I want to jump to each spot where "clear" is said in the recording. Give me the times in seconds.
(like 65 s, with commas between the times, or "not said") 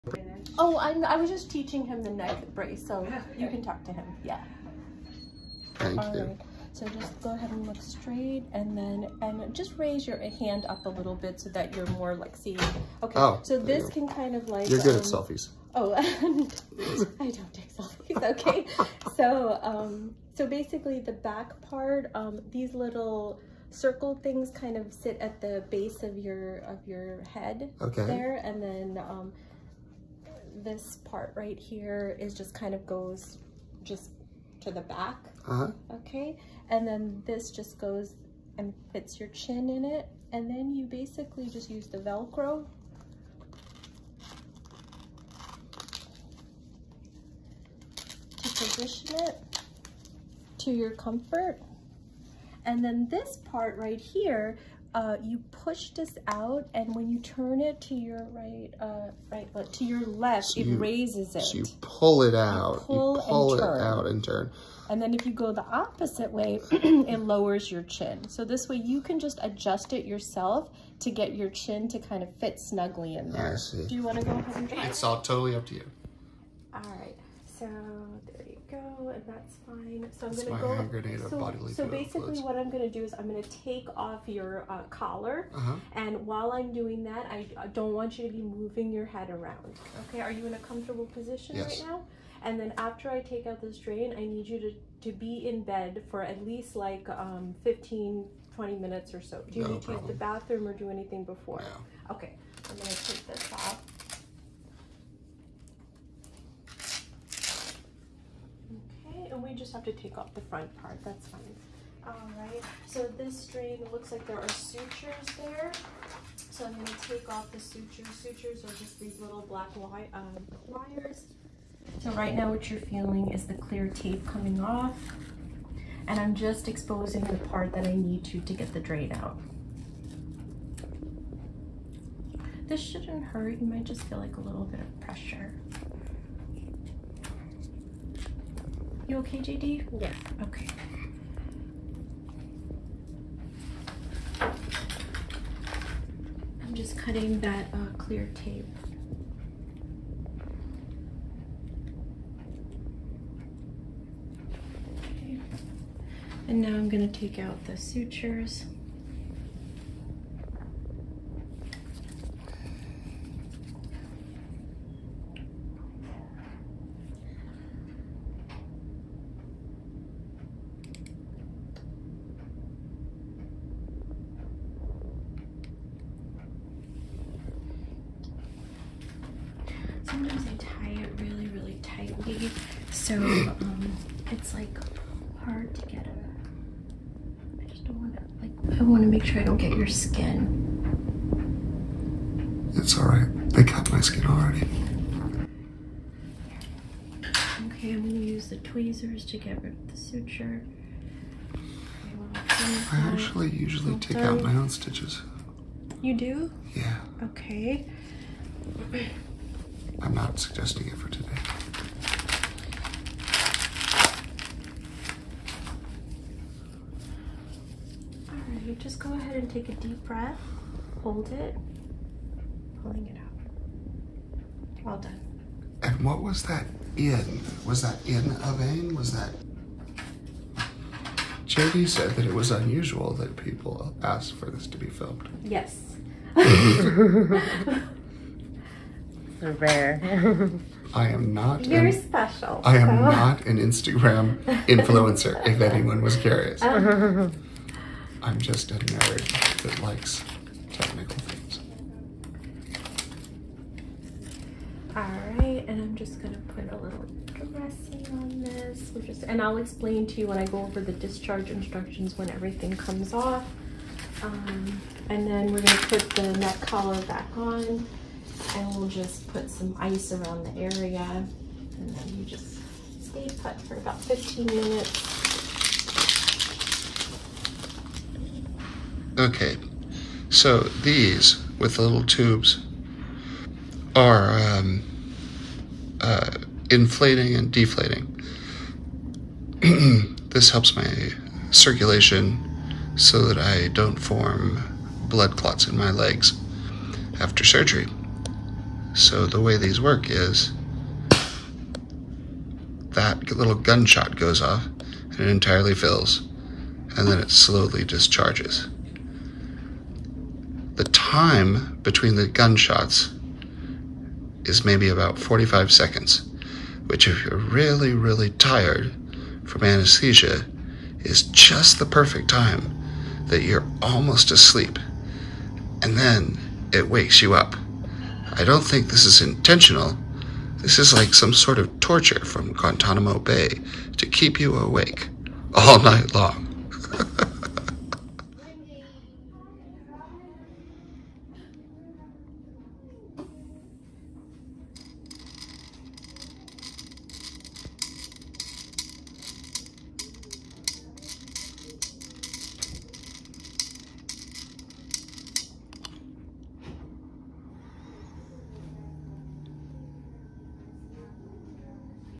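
123 s, 147 s.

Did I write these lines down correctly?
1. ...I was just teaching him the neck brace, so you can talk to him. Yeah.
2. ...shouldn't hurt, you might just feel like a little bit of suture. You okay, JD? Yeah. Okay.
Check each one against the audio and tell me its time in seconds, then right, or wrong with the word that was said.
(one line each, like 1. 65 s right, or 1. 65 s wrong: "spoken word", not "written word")
1. 1 s right
2. 132 s wrong: "pressure", not "suture".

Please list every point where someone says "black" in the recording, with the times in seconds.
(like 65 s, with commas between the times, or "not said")
119 s.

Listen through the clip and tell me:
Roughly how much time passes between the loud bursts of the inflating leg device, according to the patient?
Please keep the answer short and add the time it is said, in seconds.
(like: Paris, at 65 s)
45 seconds, at 315 s.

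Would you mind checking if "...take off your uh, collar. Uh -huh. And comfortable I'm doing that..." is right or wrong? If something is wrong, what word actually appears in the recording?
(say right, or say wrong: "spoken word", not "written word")
wrong: "while", not "comfortable".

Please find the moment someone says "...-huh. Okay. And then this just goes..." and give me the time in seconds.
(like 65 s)
35 s.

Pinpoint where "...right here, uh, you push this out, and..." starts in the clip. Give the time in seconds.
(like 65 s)
53 s.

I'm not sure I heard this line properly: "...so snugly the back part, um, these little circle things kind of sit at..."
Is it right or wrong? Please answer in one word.
wrong.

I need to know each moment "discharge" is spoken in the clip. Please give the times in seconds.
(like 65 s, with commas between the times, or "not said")
260 s, 307 s.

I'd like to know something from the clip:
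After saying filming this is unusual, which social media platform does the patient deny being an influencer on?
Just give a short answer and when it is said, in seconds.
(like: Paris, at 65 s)
Instagram, at 243 s.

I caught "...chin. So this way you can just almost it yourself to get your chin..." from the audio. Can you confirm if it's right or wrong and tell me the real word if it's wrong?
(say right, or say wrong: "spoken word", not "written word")
wrong: "adjust", not "almost".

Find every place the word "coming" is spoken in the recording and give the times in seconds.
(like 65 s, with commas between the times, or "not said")
124 s.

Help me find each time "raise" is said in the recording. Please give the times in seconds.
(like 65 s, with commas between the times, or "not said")
9 s, 60 s.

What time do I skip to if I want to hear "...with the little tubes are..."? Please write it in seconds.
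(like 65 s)
281 s.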